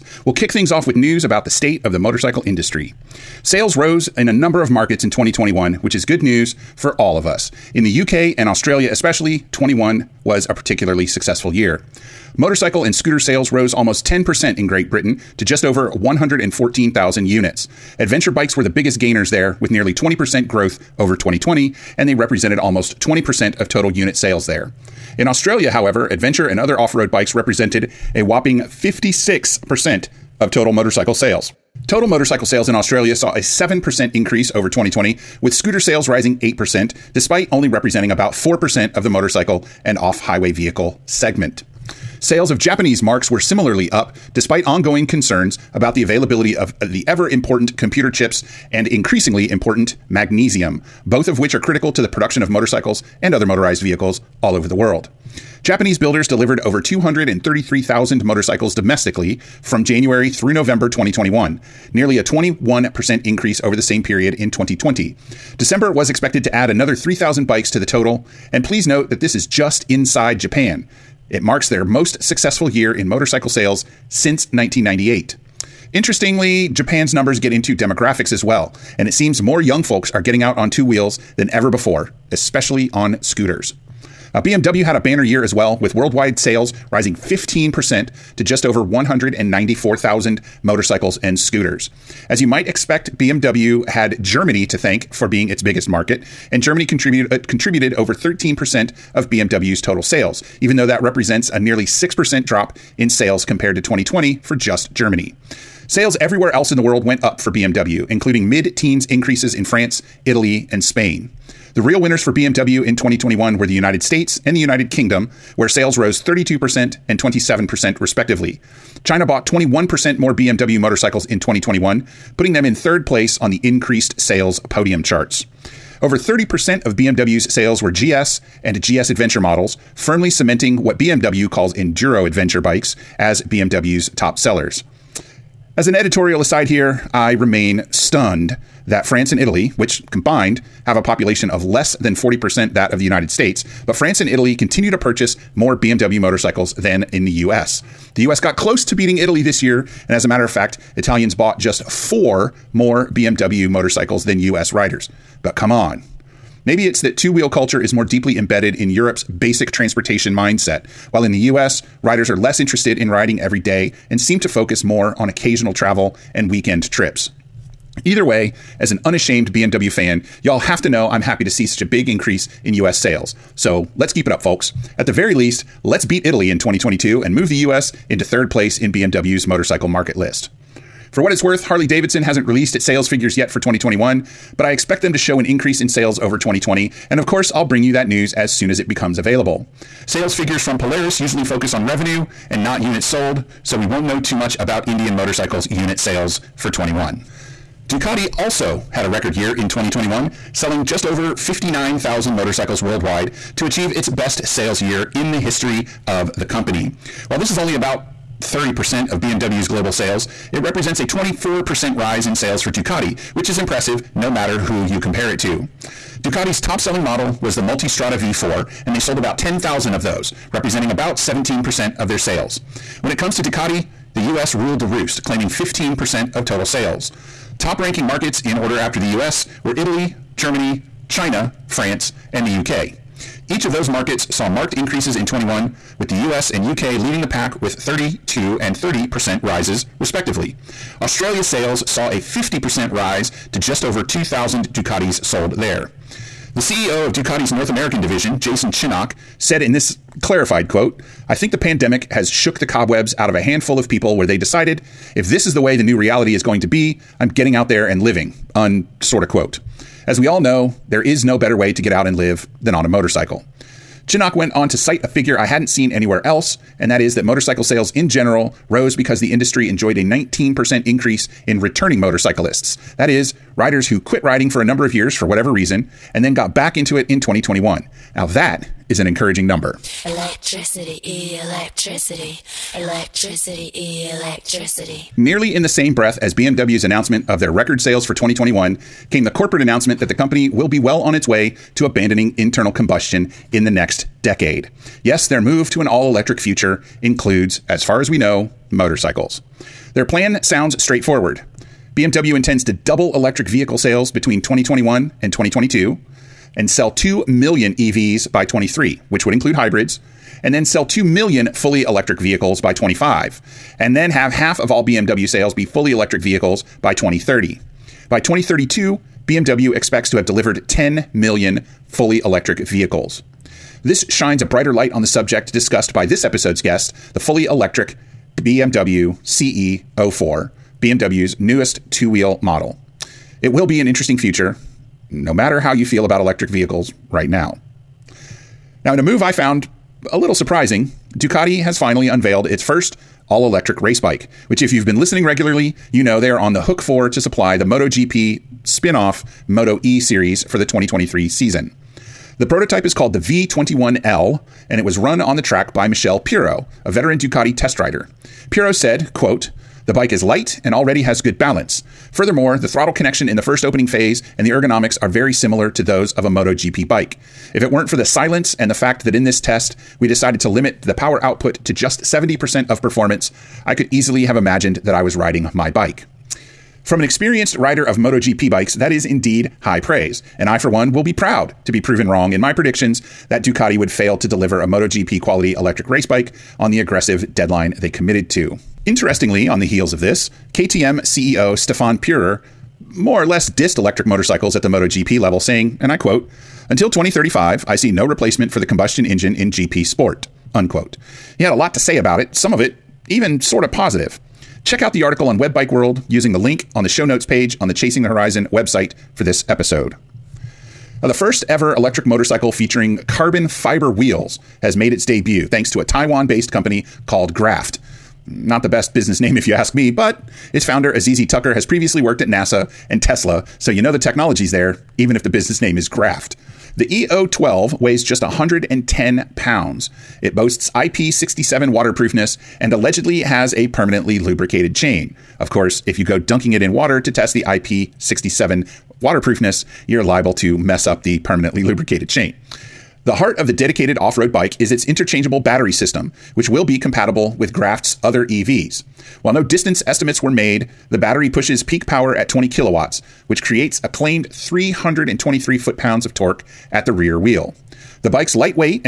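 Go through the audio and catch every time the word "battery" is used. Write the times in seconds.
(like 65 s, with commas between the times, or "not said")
445 s, 450 s.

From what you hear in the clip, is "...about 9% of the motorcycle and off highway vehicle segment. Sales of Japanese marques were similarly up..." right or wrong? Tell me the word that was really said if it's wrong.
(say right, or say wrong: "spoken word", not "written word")
wrong: "4", not "9".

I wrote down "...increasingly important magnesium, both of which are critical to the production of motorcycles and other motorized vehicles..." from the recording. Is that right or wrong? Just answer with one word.
right.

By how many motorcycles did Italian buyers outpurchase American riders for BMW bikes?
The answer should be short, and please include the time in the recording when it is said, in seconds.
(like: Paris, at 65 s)
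4, at 151 s.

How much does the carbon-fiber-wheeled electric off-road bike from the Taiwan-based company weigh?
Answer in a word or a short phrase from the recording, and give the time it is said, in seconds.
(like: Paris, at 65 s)
110 pounds, at 428 s.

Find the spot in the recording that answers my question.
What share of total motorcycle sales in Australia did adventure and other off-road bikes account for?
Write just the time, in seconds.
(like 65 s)
28 s.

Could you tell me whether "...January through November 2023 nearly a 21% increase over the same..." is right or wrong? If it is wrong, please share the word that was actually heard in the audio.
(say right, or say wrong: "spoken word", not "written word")
wrong: "2021", not "2023".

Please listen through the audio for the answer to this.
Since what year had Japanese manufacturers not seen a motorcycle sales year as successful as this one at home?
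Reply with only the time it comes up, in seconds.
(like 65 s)
74 s.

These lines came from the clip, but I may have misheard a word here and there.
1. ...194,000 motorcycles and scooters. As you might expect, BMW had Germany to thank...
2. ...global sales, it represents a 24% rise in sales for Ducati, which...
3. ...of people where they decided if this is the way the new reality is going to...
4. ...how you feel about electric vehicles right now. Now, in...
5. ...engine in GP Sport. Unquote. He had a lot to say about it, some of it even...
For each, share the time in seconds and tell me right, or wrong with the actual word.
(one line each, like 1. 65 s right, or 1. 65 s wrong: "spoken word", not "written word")
1. 88 s right
2. 209 s right
3. 253 s right
4. 335 s right
5. 399 s right.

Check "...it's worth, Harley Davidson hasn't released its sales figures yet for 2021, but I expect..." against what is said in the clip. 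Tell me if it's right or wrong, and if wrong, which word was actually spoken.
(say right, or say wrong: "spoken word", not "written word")
right.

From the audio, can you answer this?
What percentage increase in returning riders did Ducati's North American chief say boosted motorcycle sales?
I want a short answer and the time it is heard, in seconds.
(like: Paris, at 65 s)
19%, at 270 s.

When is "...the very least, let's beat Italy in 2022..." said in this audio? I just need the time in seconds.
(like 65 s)
175 s.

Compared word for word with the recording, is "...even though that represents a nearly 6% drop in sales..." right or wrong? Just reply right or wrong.
right.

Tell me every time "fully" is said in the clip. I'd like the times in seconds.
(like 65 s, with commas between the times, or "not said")
311 s, 315 s, 321 s, 327 s.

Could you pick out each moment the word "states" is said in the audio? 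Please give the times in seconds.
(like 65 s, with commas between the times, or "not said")
1 s, 114 s, 143 s.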